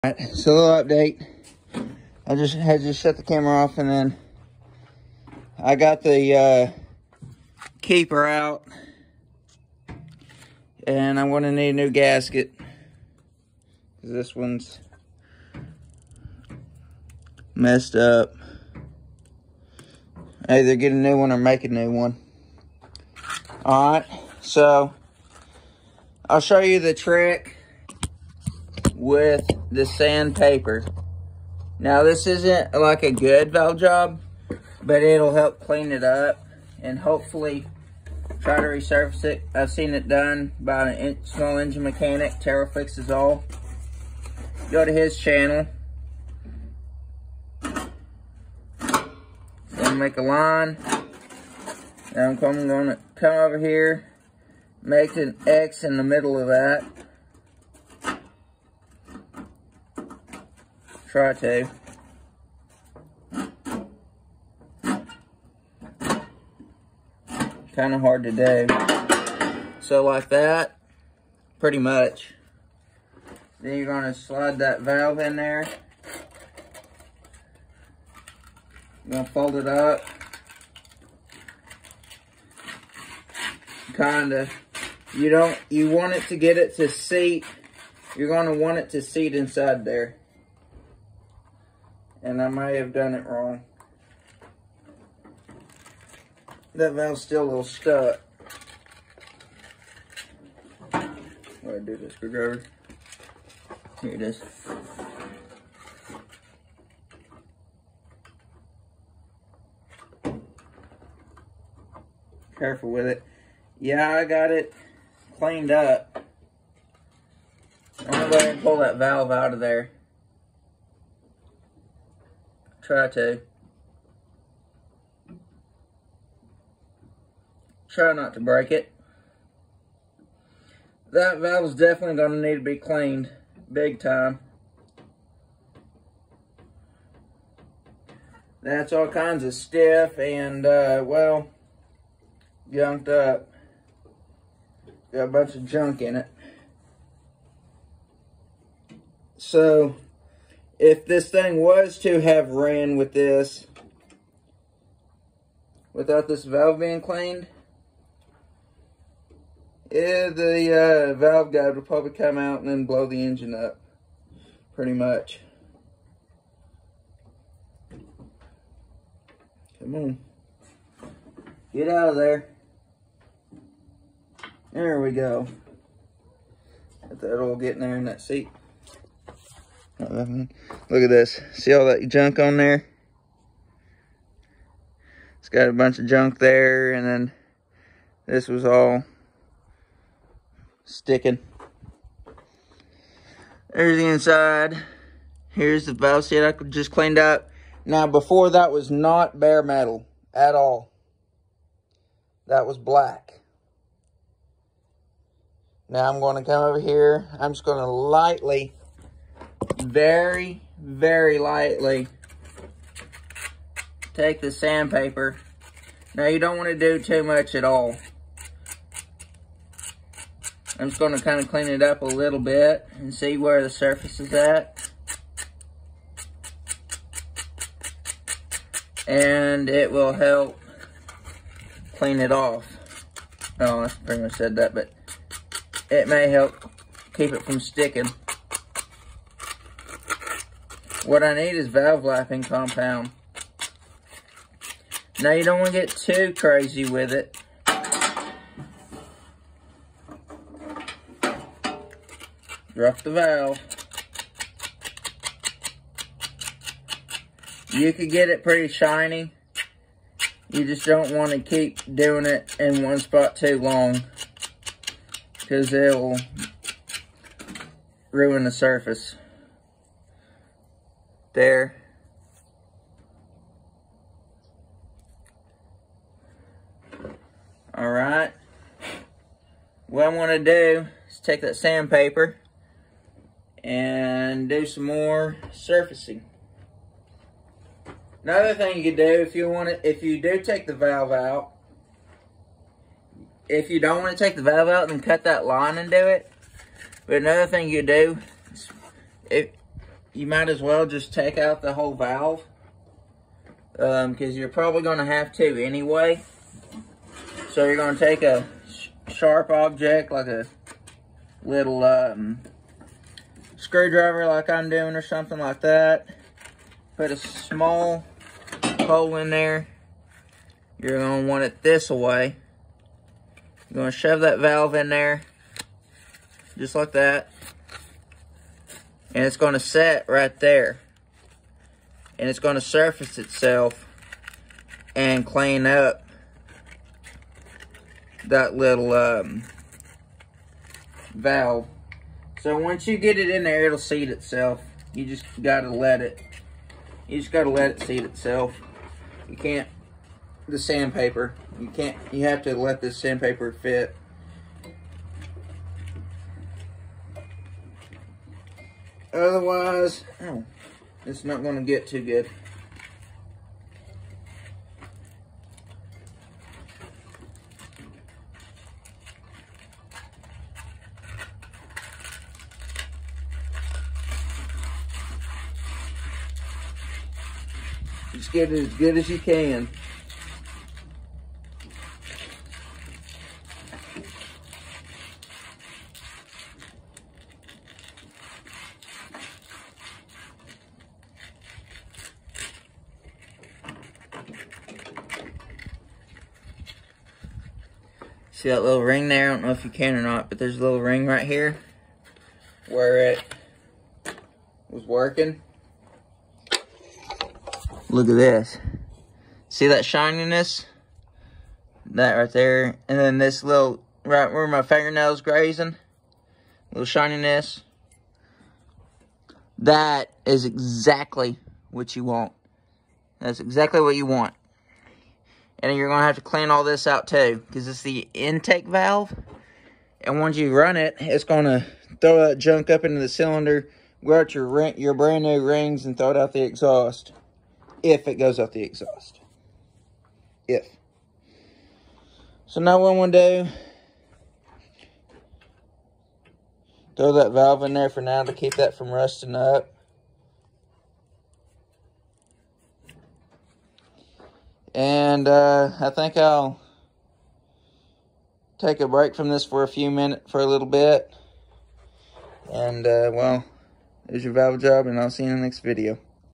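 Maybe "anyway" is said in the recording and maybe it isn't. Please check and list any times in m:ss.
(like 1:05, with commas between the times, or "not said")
5:05.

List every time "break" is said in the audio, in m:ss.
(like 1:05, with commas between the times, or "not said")
2:08, 7:38.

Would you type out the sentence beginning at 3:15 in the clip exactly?
Here's the valve seat I just cleaned up.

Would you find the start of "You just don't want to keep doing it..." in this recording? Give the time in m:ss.
4:20.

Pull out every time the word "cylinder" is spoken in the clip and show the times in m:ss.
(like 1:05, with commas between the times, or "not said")
7:13.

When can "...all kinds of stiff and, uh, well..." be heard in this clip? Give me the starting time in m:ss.
2:18.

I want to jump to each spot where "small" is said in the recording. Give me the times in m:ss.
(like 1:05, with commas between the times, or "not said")
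0:41, 5:17.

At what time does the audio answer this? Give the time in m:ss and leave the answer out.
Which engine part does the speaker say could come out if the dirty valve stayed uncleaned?
2:41.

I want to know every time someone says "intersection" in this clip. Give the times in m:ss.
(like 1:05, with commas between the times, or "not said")
not said.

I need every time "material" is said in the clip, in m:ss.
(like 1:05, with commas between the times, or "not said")
not said.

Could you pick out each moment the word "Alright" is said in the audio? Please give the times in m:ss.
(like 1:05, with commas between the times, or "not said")
0:00, 0:23.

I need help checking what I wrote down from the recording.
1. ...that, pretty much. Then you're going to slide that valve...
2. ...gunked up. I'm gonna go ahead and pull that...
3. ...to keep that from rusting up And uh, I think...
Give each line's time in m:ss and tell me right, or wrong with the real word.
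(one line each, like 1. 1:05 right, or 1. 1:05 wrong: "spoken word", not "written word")
1. 1:10 right
2. 1:55 wrong: "cleaned", not "gunked"
3. 7:28 right.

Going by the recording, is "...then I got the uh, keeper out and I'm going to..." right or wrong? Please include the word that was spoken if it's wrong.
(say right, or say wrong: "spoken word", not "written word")
right.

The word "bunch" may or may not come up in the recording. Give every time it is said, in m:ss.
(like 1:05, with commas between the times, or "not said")
2:25, 3:05.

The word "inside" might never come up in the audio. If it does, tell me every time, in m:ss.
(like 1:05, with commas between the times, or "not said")
1:29, 3:14.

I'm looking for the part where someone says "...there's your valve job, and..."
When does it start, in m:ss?
7:44.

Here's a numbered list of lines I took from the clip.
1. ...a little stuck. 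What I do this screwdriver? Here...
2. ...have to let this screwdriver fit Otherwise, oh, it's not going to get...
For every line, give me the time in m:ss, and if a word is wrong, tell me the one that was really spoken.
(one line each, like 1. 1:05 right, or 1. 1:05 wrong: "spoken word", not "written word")
1. 1:37 right
2. 5:52 wrong: "sandpaper", not "screwdriver".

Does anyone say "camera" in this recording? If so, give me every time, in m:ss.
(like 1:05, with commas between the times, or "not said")
0:03.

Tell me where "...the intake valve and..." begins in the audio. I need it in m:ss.
7:07.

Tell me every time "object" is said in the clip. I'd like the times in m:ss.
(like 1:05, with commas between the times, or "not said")
5:09.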